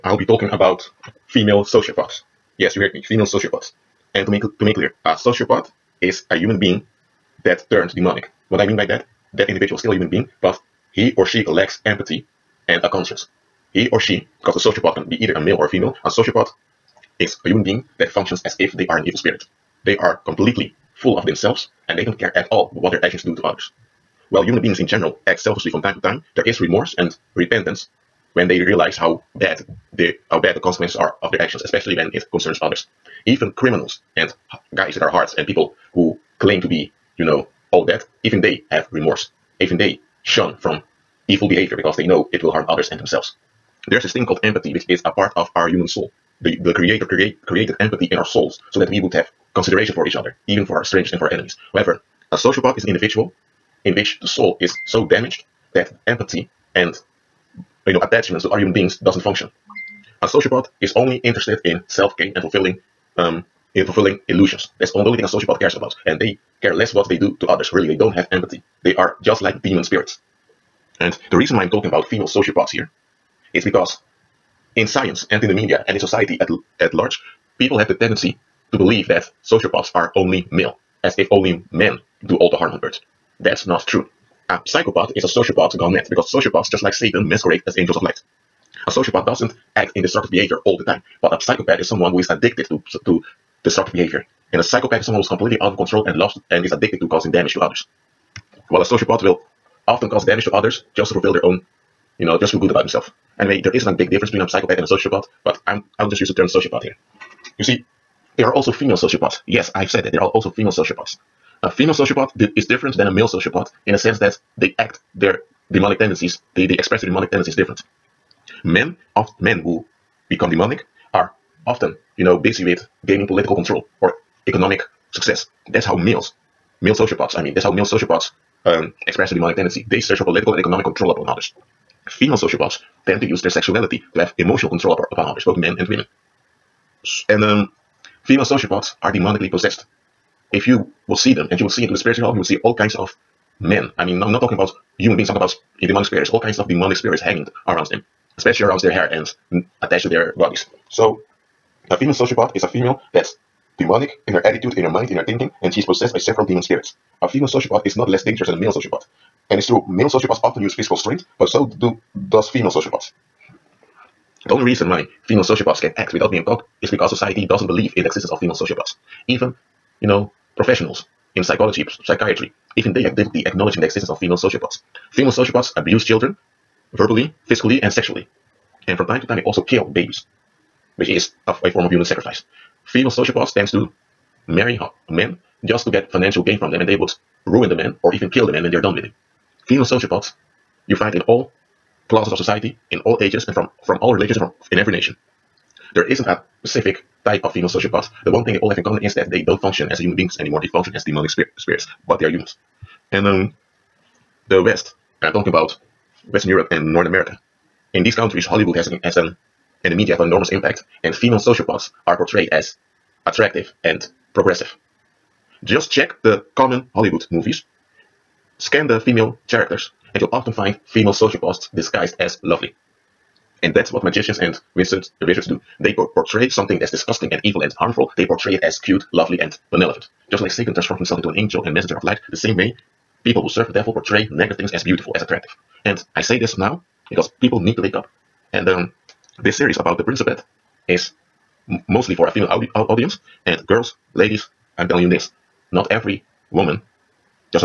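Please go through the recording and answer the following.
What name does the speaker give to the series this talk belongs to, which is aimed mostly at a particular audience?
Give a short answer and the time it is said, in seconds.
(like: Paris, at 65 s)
the Principate, at 239 s.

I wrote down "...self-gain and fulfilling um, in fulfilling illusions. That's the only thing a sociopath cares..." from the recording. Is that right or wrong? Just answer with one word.
right.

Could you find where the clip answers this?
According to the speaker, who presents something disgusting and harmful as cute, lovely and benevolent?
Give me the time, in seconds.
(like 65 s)
224 s.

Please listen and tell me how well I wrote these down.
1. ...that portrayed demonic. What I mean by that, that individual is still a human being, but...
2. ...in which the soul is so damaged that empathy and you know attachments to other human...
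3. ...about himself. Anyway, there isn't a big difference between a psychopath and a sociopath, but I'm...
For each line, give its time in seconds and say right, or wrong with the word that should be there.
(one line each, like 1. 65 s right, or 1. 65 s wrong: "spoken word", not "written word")
1. 7 s wrong: "turned", not "portrayed"
2. 53 s right
3. 102 s right.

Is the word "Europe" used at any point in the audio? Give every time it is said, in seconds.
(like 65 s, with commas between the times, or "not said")
206 s.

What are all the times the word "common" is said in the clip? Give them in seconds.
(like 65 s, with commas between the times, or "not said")
198 s, 216 s.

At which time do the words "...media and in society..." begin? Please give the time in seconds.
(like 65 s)
75 s.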